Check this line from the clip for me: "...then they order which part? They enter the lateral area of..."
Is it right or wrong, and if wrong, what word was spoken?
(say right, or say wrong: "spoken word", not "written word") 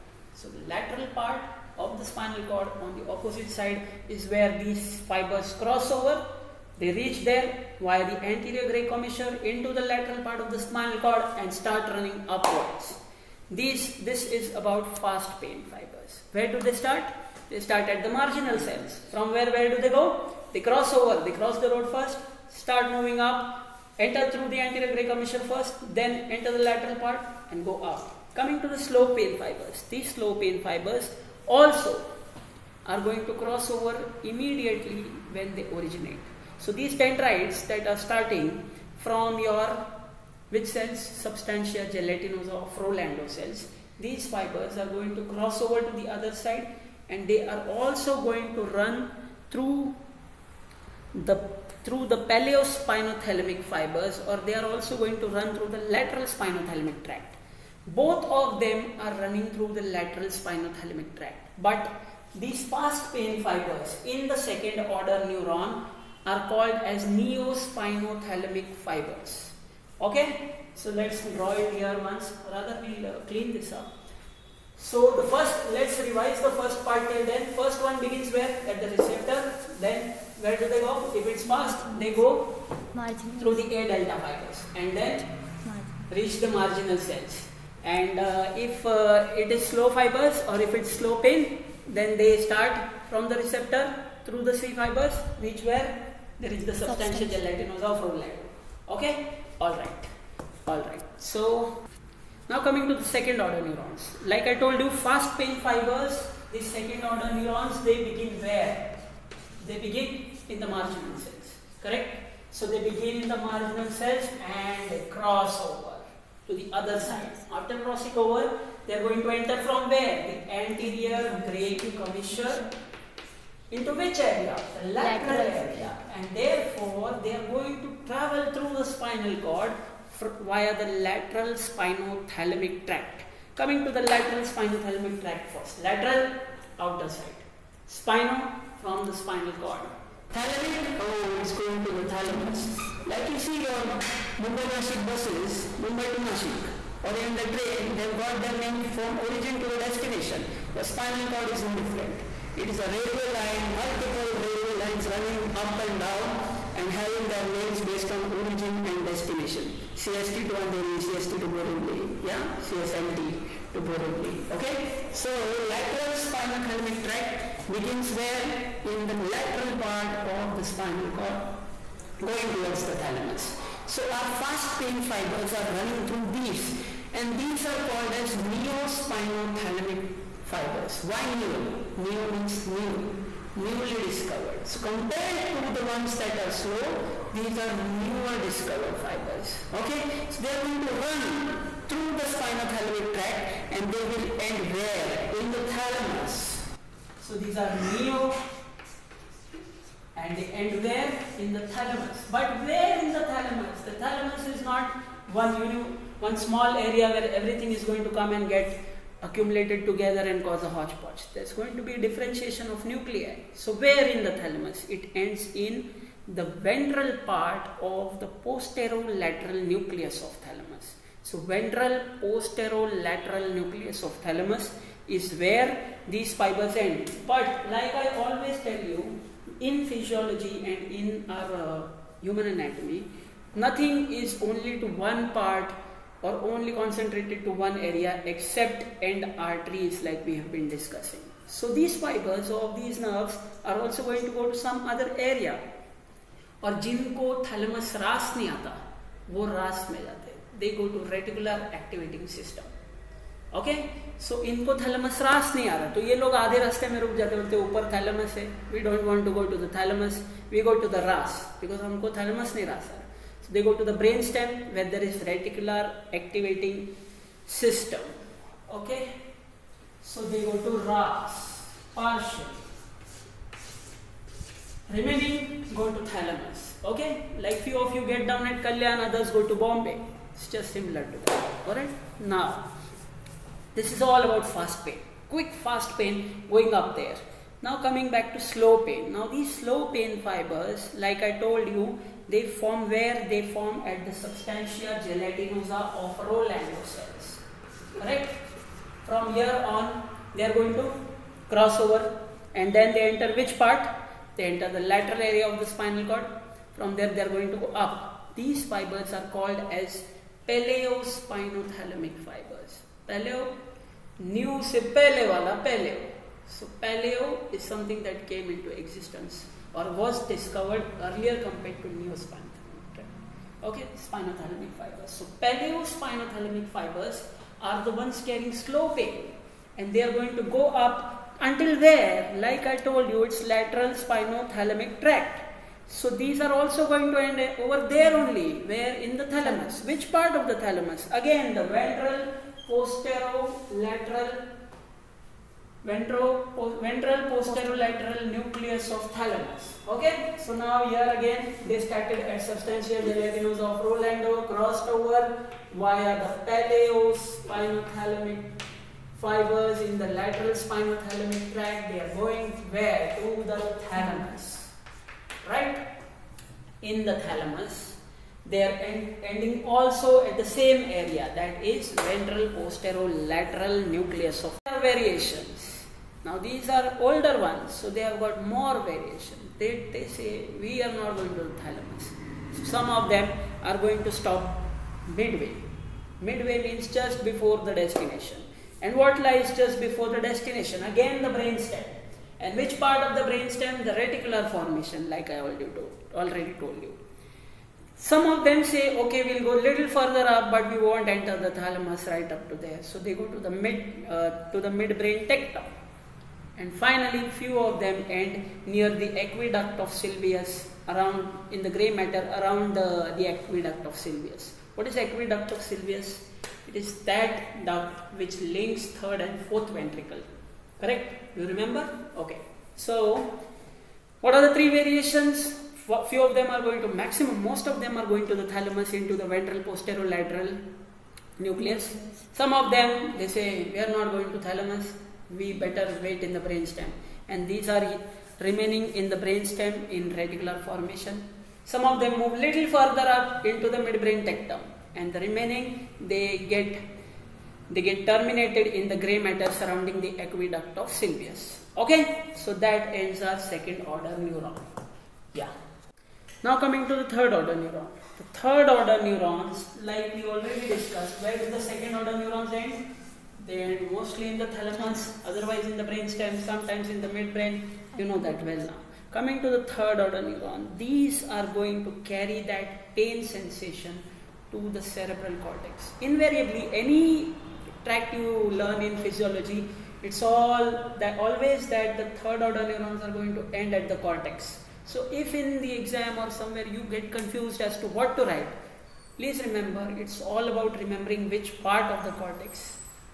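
wrong: "enter", not "order".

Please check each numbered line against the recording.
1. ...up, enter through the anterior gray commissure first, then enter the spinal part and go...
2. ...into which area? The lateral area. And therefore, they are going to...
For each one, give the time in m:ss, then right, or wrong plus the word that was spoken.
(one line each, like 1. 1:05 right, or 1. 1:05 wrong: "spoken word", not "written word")
1. 0:23 wrong: "lateral", not "spinal"
2. 2:03 right.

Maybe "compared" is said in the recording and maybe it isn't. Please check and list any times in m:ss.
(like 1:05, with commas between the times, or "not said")
3:04, 5:21.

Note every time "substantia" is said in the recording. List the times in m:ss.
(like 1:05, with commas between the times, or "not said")
0:41, 1:36, 4:54, 5:52.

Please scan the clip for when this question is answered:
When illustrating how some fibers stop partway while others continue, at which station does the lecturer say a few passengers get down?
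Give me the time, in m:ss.
4:38.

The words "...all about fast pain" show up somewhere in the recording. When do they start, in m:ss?
4:44.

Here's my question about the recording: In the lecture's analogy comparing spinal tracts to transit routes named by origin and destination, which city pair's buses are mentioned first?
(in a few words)
Mumbai-Nashik.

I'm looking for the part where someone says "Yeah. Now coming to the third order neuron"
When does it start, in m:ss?
7:35.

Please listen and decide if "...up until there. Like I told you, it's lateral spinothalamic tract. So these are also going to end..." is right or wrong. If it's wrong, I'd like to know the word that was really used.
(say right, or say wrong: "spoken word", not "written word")
right.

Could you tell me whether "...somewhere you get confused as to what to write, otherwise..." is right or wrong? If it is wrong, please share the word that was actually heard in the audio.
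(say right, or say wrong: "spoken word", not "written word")
wrong: "please", not "otherwise".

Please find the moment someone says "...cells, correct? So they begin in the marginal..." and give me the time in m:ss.
1:51.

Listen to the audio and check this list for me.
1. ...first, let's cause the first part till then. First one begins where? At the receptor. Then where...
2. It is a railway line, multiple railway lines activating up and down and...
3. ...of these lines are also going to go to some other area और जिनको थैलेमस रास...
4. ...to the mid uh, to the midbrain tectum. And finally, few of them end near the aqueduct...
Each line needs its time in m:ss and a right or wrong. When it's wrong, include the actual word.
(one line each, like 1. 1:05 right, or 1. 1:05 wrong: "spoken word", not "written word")
1. 1:15 wrong: "revise", not "cause"
2. 2:32 wrong: "running", not "activating"
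3. 4:02 wrong: "nerves", not "lines"
4. 6:43 right.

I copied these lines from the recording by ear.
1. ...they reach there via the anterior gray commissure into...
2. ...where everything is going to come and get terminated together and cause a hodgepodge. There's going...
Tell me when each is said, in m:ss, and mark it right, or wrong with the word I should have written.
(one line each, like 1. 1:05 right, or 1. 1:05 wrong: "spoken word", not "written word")
1. 0:06 right
2. 3:27 wrong: "accumulated", not "terminated".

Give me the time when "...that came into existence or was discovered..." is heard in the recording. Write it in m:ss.
5:18.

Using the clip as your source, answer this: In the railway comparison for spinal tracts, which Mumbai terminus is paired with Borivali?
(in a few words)
CSMT.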